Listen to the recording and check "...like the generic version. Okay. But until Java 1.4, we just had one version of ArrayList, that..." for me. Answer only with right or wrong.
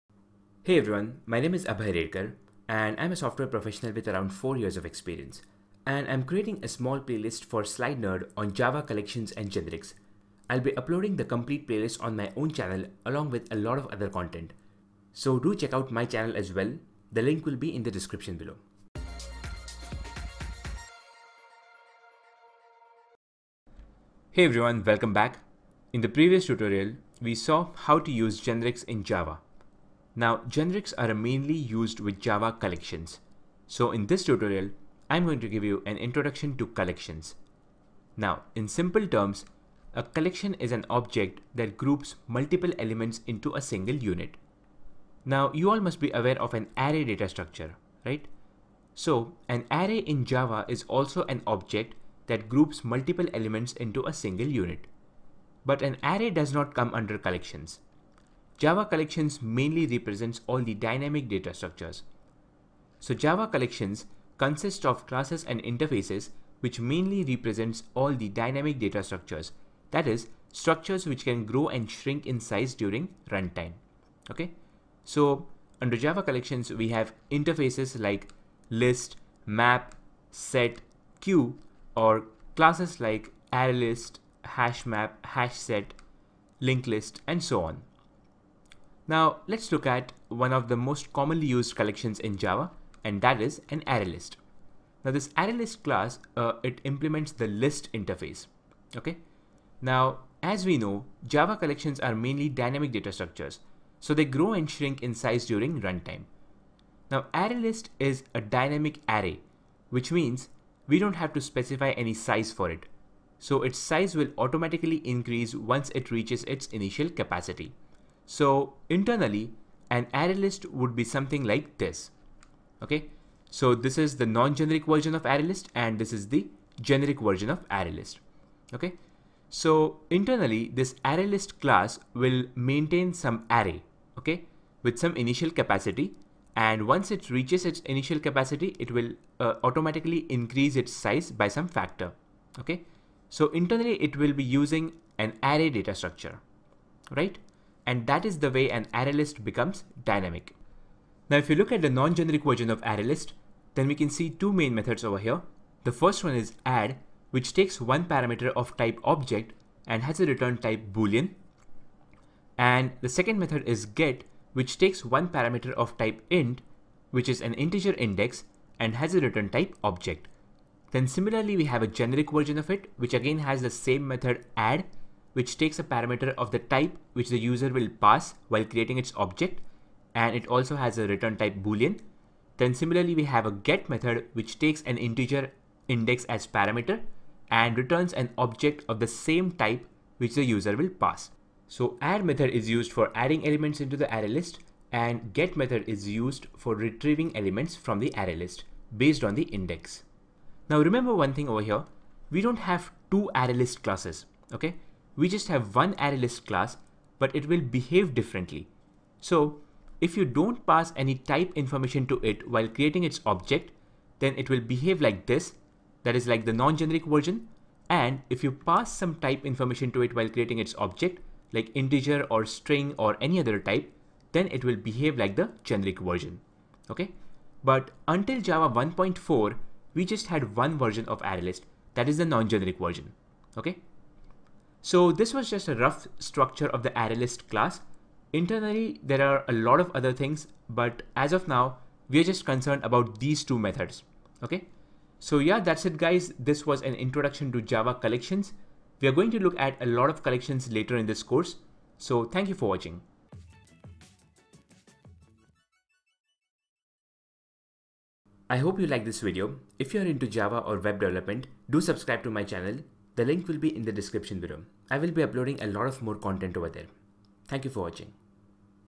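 right.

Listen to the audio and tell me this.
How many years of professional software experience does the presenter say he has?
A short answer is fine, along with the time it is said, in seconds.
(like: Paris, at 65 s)
4, at 4 s.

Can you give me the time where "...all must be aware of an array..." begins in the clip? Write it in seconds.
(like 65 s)
45 s.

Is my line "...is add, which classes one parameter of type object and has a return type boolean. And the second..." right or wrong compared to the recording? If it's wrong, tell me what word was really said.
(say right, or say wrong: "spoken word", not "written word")
wrong: "takes", not "classes".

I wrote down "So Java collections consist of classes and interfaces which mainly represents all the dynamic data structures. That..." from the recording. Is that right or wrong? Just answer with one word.
right.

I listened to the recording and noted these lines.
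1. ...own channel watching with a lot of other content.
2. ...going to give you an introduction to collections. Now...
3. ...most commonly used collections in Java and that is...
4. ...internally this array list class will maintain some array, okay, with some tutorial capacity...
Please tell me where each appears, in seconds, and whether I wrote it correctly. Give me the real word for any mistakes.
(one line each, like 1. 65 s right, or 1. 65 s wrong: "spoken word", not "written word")
1. 12 s wrong: "along", not "watching"
2. 35 s right
3. 90 s right
4. 130 s wrong: "initial", not "tutorial".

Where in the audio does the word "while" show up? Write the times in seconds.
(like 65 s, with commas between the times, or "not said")
178 s, 212 s, 220 s.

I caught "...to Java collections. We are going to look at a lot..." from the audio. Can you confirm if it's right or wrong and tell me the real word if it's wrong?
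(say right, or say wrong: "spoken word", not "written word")
right.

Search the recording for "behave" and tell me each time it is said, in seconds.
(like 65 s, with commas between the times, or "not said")
207 s, 214 s, 224 s.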